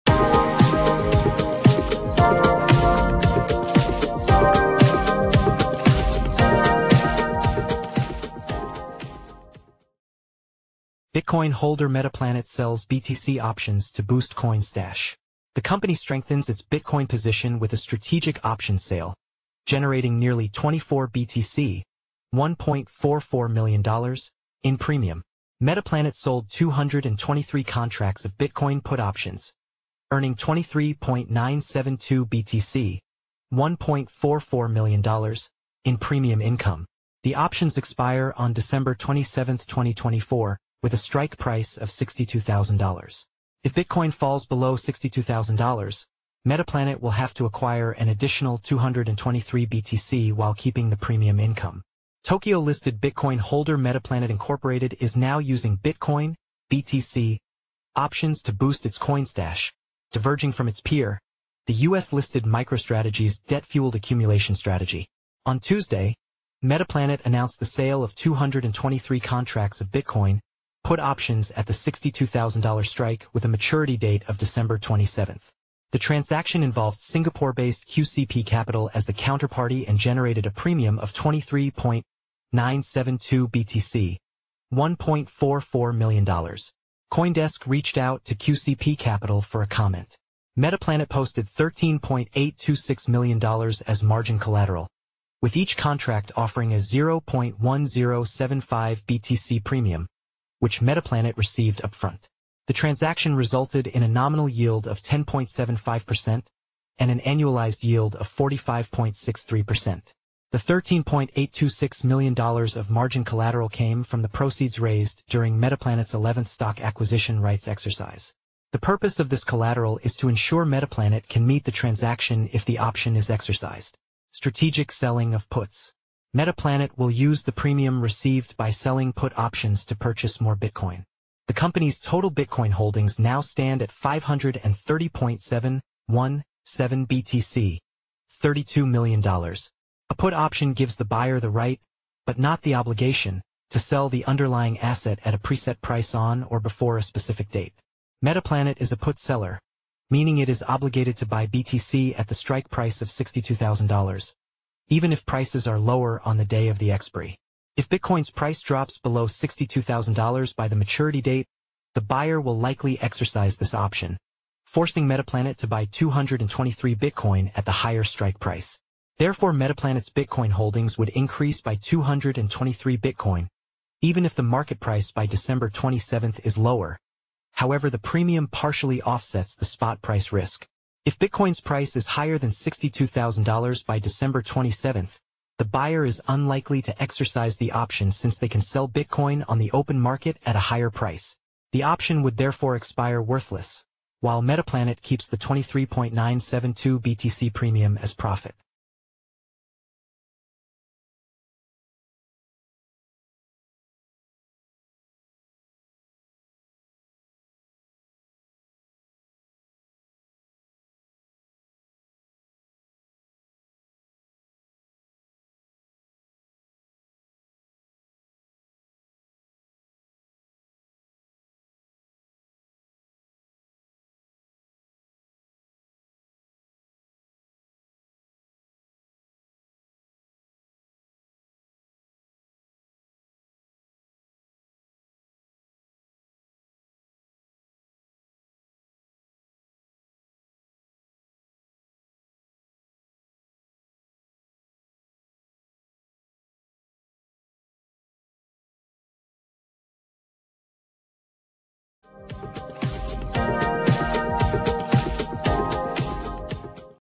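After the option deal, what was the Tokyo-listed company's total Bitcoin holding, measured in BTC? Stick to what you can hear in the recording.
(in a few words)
530.717 BTC.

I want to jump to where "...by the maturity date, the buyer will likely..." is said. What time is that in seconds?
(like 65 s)
160 s.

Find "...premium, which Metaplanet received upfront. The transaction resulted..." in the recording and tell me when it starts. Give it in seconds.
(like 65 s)
99 s.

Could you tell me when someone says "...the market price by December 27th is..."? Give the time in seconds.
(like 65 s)
174 s.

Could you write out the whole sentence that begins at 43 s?
If Bitcoin falls below $62,000, Metaplanet will have to acquire an additional 223 BTC while keeping the premium income.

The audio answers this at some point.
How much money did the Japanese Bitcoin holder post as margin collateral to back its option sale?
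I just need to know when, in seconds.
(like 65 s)
91 s.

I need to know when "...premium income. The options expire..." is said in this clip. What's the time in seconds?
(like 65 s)
35 s.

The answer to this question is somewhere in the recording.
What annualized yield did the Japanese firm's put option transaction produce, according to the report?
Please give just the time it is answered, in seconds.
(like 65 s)
108 s.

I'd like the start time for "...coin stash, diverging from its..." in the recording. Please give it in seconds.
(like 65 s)
58 s.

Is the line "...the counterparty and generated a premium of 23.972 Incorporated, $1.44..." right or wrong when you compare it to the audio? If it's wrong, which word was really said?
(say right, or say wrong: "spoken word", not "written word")
wrong: "BTC", not "Incorporated".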